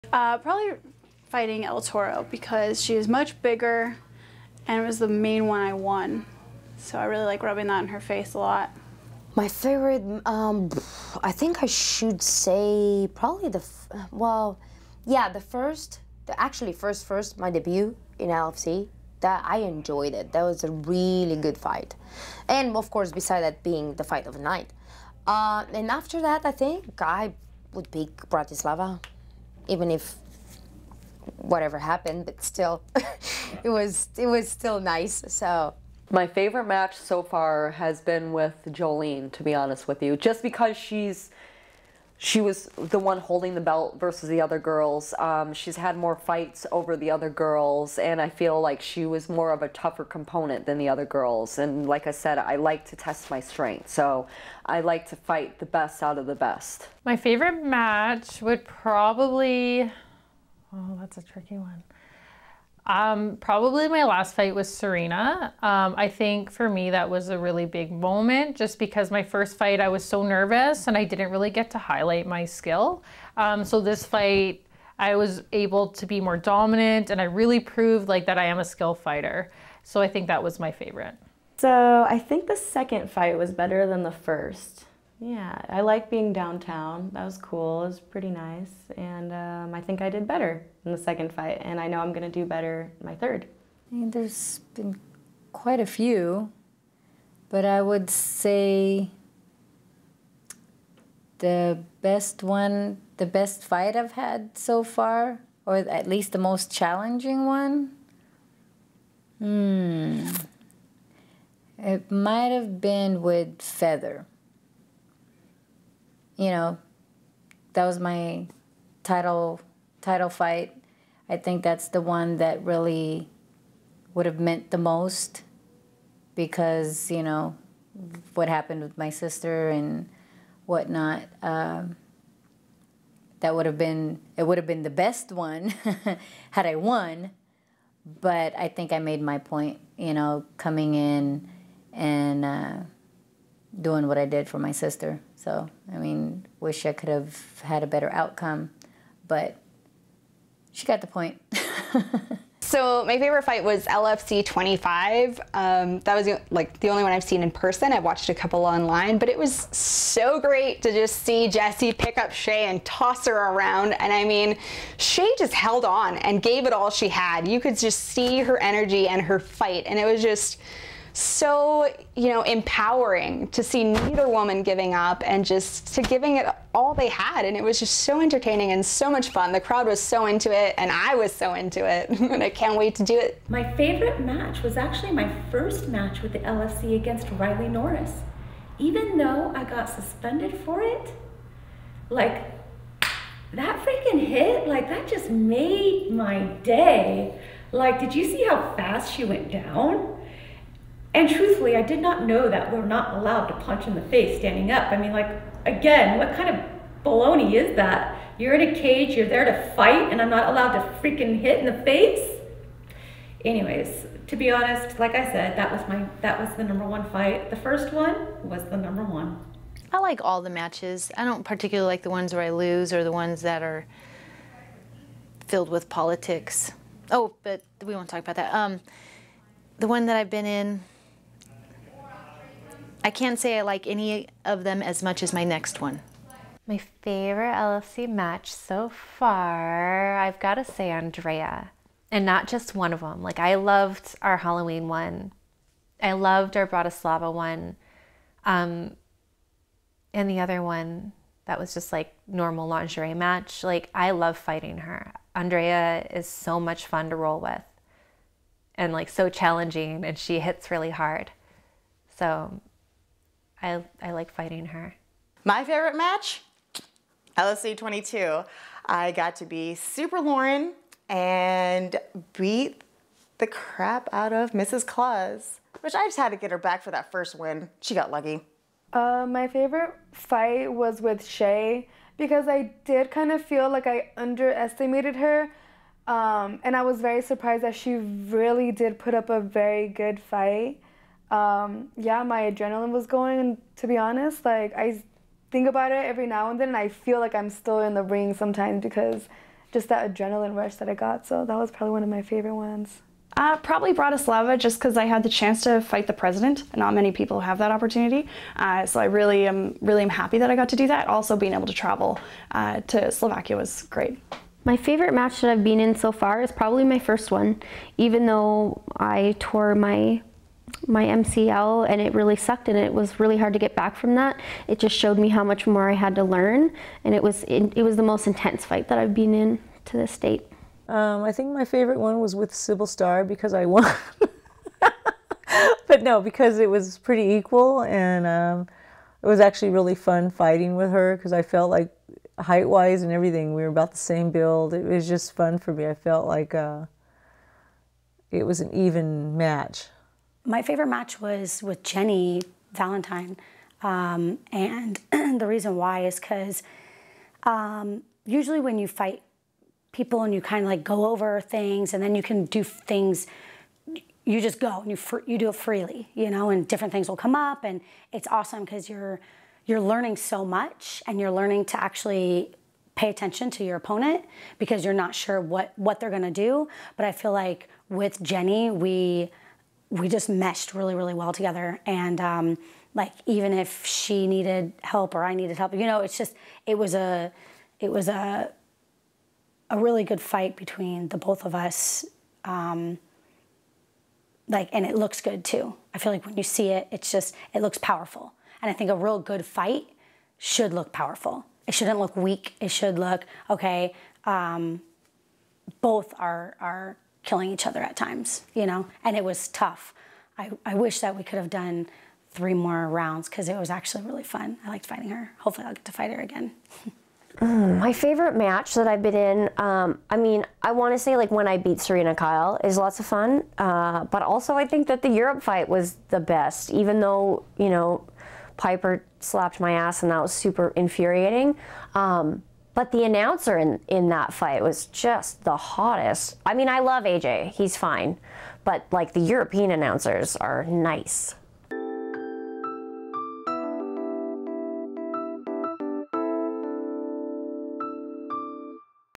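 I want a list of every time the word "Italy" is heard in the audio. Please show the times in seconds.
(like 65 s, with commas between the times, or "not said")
not said.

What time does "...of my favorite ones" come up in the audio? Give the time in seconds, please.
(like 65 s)
302 s.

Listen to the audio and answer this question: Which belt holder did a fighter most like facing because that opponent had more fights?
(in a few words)
Jolene.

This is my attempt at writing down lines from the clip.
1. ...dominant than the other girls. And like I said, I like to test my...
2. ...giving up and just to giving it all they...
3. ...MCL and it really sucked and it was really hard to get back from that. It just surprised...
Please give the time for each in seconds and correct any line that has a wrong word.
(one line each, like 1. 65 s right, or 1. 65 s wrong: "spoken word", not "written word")
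1. 50 s wrong: "component", not "dominant"
2. 174 s right
3. 321 s wrong: "showed", not "surprised".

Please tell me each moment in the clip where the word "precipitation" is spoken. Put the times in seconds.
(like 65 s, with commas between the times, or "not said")
not said.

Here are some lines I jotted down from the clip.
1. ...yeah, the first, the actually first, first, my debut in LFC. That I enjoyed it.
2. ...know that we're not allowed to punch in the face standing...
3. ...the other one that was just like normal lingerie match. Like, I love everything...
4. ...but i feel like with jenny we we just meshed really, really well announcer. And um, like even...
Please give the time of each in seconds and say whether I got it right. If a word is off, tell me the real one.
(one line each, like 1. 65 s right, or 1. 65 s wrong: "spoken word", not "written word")
1. 15 s right
2. 202 s right
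3. 250 s wrong: "fighting", not "everything"
4. 376 s wrong: "together", not "announcer".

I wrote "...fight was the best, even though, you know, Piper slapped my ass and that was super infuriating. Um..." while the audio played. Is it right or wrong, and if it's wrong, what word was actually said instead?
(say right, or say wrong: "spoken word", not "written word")
right.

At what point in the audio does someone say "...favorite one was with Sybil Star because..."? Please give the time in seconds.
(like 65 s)
331 s.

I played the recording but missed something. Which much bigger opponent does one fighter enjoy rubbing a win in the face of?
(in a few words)
El Toro.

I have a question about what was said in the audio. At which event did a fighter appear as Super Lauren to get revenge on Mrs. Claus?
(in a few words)
LFC 22.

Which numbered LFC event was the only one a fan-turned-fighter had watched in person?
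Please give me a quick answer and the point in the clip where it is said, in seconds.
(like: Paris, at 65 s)
LFC 25, at 153 s.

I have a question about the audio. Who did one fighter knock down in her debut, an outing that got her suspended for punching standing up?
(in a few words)
Riley Norris.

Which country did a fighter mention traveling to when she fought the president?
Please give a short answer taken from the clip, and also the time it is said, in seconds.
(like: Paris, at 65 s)
Slovakia, at 313 s.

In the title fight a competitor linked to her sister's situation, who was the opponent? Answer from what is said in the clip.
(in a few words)
Feather.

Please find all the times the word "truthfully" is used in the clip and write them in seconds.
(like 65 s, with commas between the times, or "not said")
201 s.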